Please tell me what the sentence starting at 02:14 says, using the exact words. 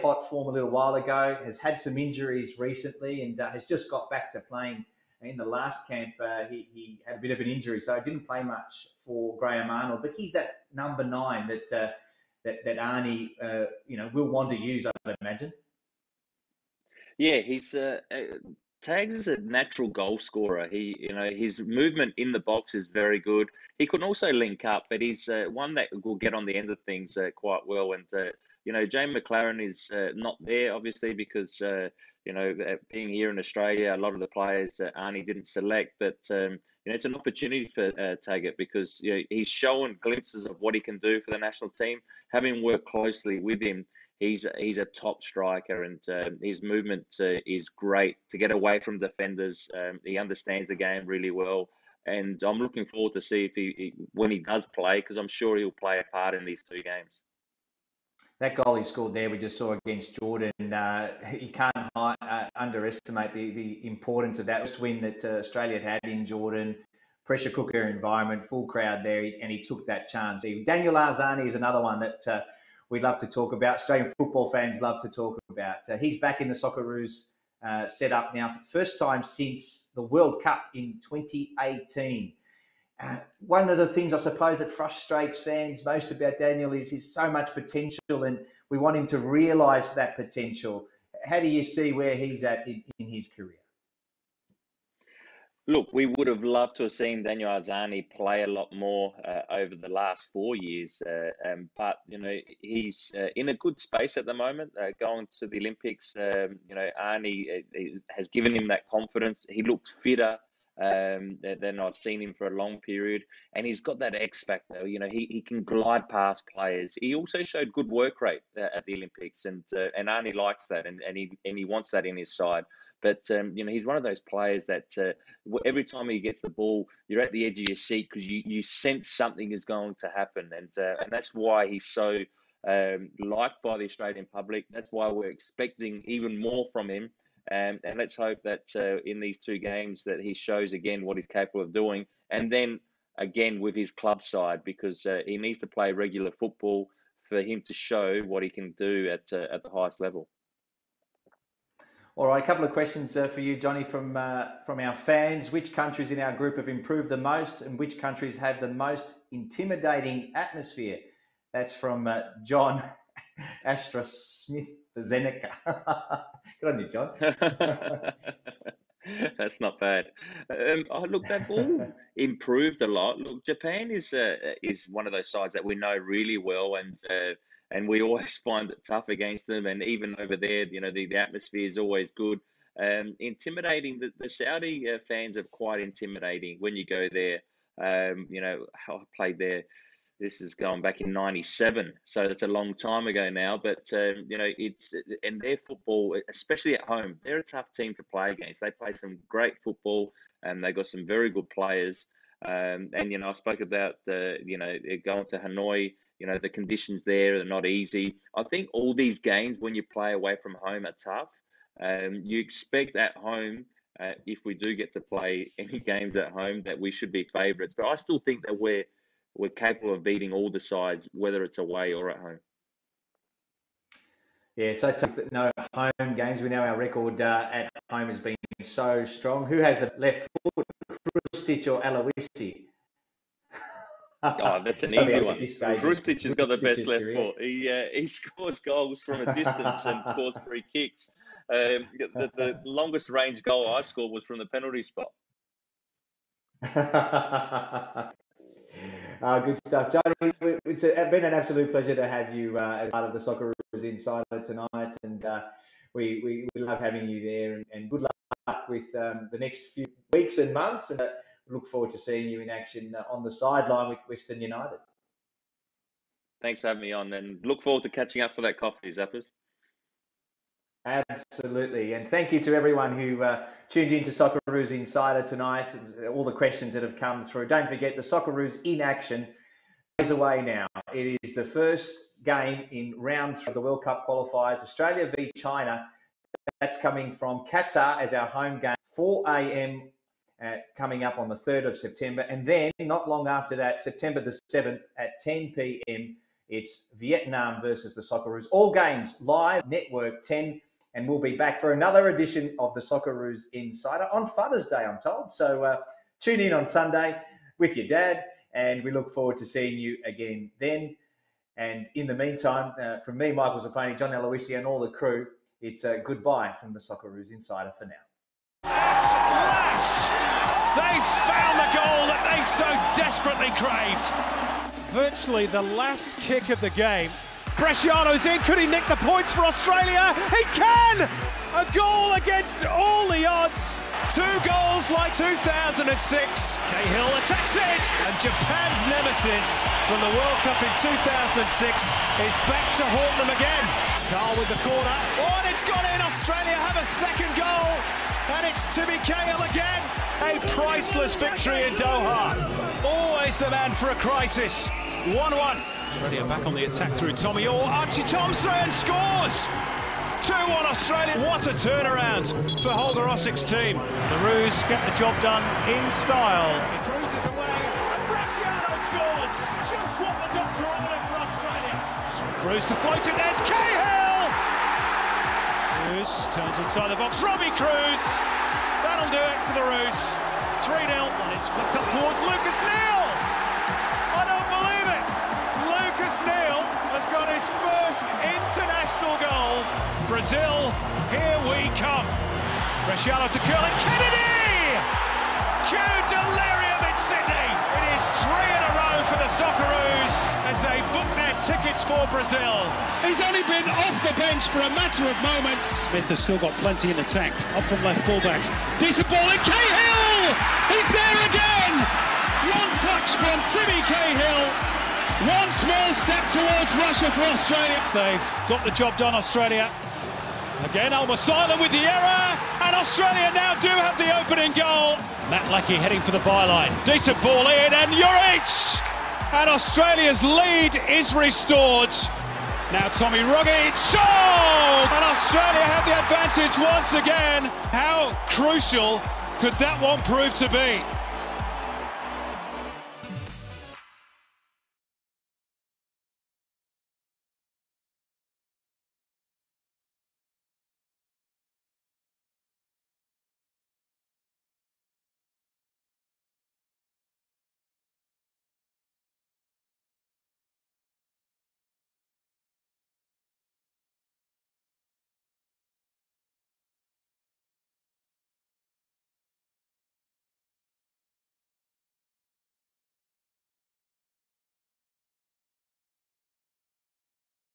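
That's why we're expecting even more from him.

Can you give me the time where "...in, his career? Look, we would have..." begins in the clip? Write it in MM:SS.
01:32.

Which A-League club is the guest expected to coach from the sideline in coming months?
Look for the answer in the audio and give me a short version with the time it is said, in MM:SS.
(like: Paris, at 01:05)
Western United, at 04:24.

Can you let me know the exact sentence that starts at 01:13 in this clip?
Australian football fans love to talk about.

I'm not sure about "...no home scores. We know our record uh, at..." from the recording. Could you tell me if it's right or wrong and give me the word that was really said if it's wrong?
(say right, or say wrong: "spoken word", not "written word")
wrong: "games", not "scores".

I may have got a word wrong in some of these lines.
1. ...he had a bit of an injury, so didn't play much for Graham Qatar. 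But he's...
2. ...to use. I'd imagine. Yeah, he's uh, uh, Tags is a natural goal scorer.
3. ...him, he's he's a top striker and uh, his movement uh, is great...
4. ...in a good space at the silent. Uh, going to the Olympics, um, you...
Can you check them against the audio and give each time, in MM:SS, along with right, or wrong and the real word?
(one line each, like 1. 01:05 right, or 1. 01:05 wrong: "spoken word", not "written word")
1. 00:06 wrong: "Arnold", not "Qatar"
2. 00:14 right
3. 00:43 right
4. 01:43 wrong: "moment", not "silent".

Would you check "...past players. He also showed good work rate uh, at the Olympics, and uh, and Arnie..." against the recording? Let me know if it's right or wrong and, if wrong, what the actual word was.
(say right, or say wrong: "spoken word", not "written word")
right.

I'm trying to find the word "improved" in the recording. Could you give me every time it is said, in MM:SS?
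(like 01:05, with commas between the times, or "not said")
02:36, 02:52.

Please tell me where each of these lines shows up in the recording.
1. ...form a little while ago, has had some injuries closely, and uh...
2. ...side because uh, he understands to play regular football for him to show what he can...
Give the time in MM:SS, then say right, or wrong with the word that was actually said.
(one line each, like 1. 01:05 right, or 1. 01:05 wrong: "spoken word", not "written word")
1. 00:00 wrong: "recently", not "closely"
2. 02:24 wrong: "needs", not "understands".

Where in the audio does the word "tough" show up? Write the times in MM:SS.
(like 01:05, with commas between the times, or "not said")
02:58, 03:17, 03:31.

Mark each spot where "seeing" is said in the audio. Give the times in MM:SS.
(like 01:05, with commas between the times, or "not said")
04:21, 05:09.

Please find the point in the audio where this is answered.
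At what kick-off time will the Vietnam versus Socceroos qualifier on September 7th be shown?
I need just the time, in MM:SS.
04:55.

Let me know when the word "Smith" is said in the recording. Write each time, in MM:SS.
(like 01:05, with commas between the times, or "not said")
02:44, 06:45.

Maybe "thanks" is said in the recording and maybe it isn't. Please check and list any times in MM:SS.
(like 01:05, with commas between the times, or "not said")
04:26, 04:32.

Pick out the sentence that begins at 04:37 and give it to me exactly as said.
Don't forget the Socceroos in action is away now.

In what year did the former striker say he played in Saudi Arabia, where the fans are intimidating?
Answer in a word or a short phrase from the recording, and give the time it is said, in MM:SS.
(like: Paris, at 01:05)
1997, at 03:11.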